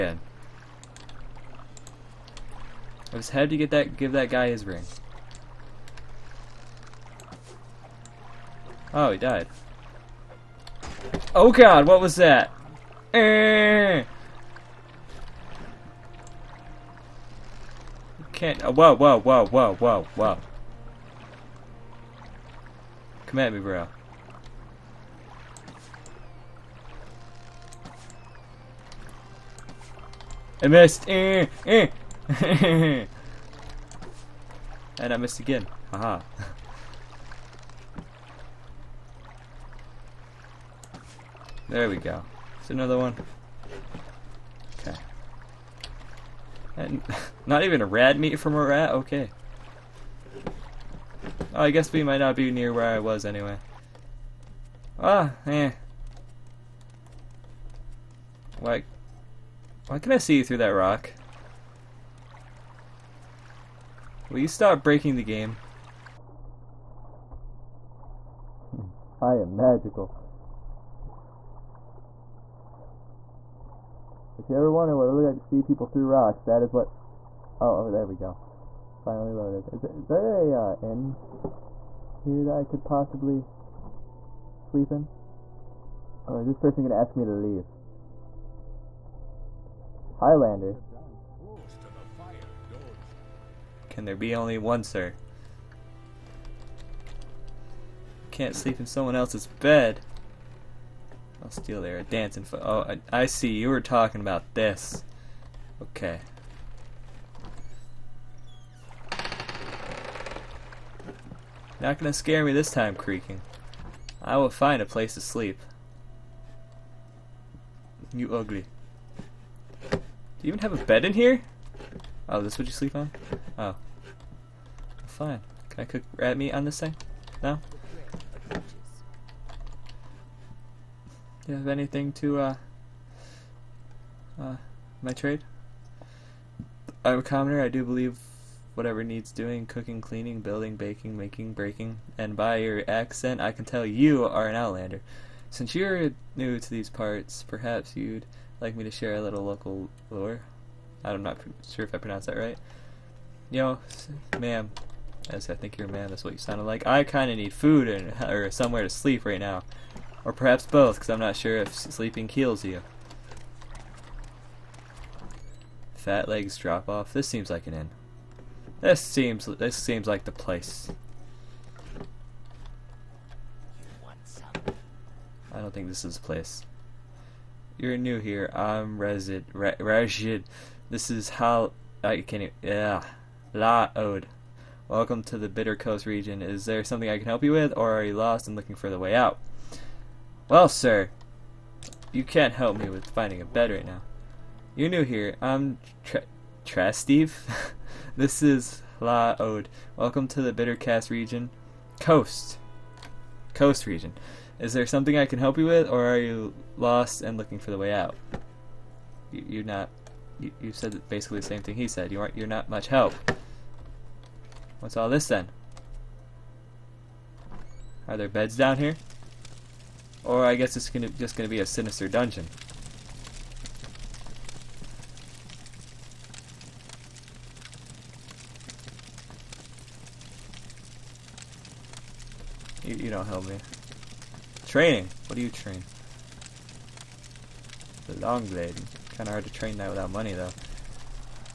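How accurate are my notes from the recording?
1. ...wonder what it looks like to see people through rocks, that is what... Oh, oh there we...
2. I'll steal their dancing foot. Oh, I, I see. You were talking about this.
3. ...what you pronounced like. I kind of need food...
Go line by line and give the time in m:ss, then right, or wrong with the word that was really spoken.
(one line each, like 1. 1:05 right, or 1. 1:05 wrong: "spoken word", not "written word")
1. 1:14 right
2. 1:41 right
3. 2:36 wrong: "sounded", not "pronounced".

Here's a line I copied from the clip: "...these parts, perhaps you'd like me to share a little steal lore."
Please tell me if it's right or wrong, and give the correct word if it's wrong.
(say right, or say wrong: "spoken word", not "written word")
wrong: "local", not "steal".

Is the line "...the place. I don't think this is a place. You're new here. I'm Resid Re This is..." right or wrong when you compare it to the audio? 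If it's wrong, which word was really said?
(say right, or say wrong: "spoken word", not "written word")
right.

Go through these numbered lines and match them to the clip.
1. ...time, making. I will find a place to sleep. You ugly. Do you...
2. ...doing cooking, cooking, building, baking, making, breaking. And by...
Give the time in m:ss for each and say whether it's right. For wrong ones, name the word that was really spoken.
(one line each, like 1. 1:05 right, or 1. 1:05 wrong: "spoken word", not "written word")
1. 1:52 wrong: "creaking", not "making"
2. 2:19 wrong: "cleaning", not "cooking".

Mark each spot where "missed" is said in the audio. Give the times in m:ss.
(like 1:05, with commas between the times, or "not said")
0:30, 0:35.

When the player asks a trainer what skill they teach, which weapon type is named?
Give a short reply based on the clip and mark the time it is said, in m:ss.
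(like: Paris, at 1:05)
The long blade, at 3:58.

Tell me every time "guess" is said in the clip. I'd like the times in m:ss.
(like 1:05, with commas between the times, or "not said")
0:51, 3:40.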